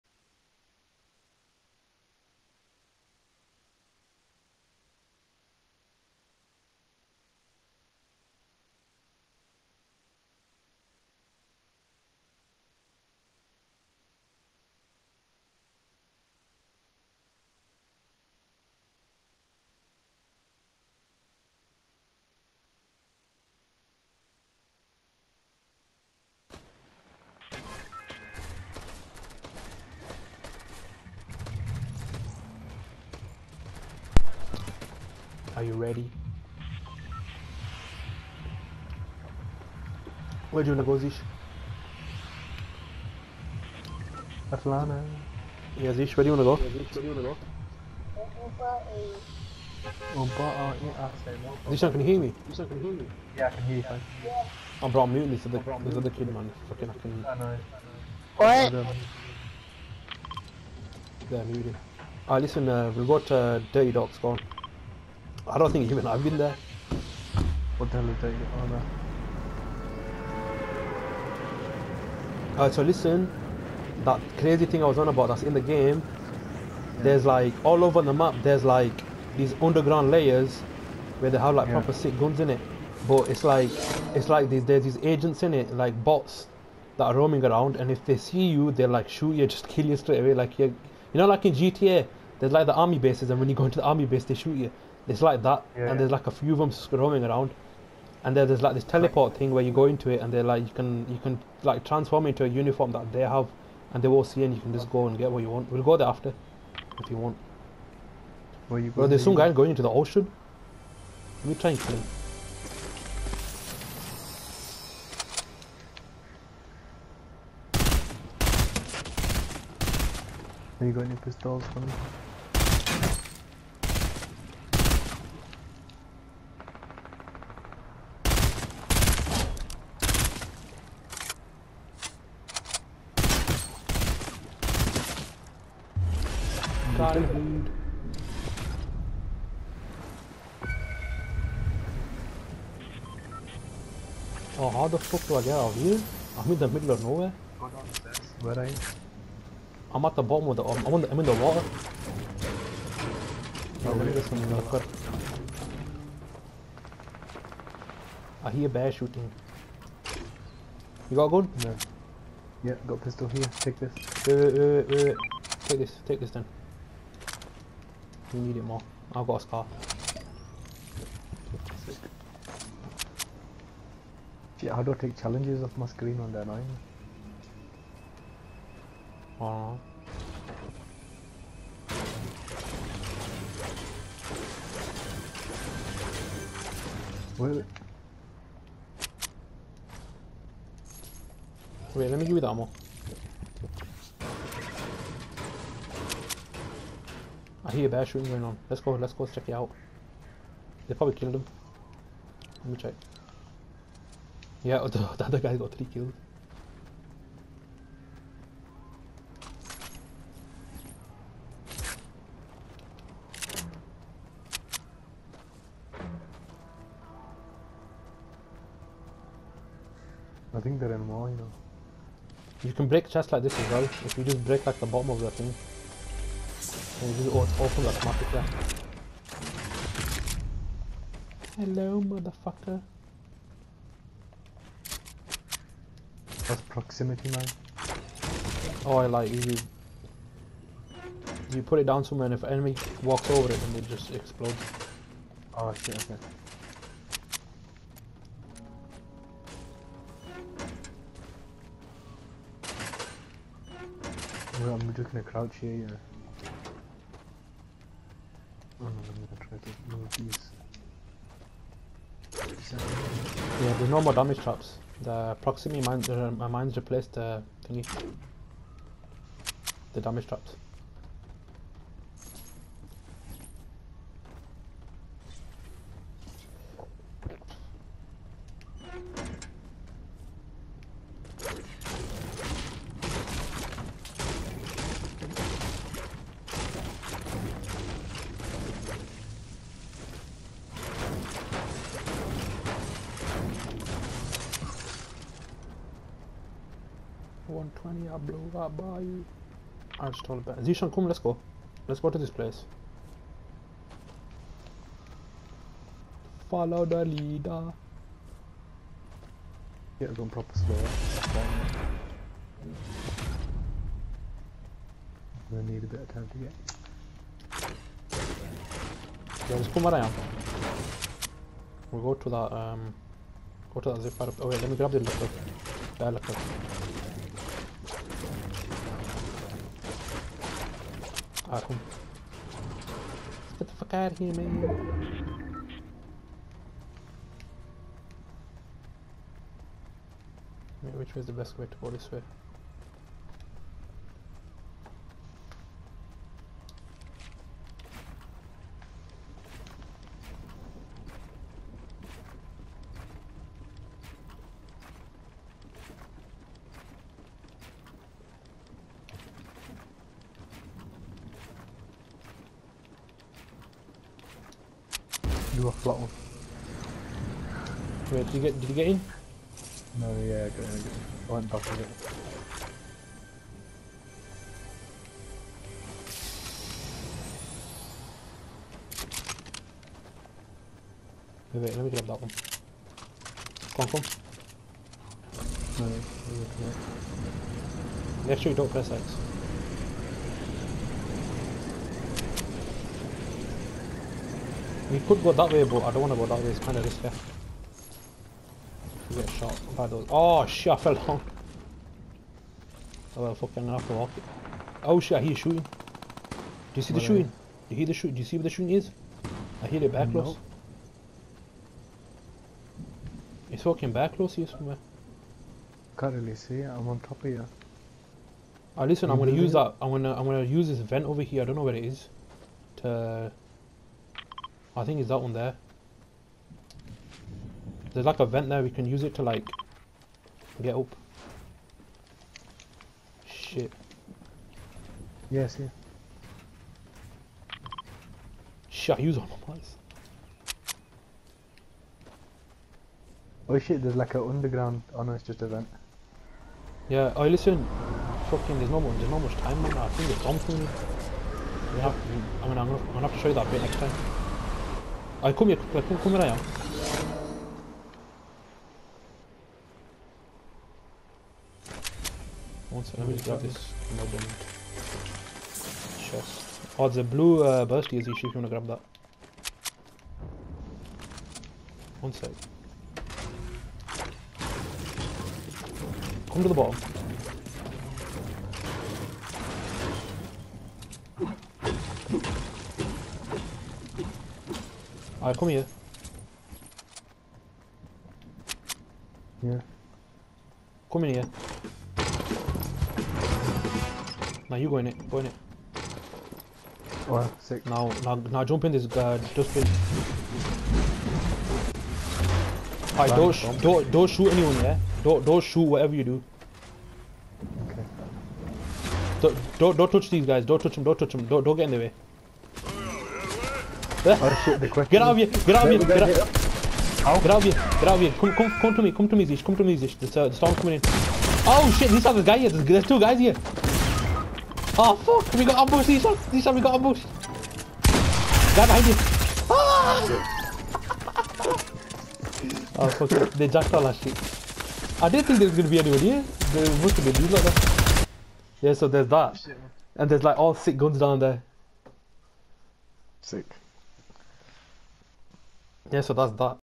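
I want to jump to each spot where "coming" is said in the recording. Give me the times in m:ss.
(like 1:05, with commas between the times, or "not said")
8:40.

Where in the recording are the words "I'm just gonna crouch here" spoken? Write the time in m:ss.
4:14.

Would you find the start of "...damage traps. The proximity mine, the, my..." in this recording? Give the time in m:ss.
4:24.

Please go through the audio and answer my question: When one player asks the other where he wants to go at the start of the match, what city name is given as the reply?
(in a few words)
Atlanta.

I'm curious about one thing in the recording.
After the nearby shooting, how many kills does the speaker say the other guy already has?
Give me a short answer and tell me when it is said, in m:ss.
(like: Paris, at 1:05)
3, at 3:25.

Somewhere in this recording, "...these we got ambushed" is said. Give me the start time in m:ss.
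8:46.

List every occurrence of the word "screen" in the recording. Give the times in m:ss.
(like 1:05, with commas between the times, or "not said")
2:55.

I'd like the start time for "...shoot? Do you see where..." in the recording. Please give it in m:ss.
6:47.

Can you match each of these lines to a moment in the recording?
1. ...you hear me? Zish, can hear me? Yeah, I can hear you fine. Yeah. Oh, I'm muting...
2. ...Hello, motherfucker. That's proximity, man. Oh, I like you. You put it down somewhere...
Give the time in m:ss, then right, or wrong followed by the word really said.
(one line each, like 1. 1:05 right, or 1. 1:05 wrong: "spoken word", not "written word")
1. 0:51 right
2. 3:51 right.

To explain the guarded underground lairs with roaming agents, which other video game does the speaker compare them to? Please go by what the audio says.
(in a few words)
GTA.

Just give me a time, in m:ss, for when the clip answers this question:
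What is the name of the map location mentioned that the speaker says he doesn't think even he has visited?
1:03.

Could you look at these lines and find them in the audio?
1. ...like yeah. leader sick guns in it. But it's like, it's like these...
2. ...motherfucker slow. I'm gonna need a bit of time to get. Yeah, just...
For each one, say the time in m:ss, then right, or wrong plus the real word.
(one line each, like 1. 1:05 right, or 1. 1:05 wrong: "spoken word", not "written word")
1. 1:21 wrong: "proper", not "leader"
2. 5:10 wrong: "proper", not "motherfucker".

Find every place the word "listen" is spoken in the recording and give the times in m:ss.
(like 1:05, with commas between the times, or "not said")
1:02, 1:12, 6:58, 7:27.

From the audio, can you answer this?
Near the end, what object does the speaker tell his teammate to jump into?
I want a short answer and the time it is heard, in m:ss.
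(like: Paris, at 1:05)
Dustbin, at 8:19.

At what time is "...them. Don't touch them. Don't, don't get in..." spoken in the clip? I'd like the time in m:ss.
8:30.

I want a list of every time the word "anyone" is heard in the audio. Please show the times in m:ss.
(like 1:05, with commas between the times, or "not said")
8:24, 8:55.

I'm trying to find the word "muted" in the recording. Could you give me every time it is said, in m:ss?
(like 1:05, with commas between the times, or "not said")
1:01.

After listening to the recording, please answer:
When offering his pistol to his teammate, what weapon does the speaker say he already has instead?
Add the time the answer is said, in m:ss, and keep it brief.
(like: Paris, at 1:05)
Scar, at 2:49.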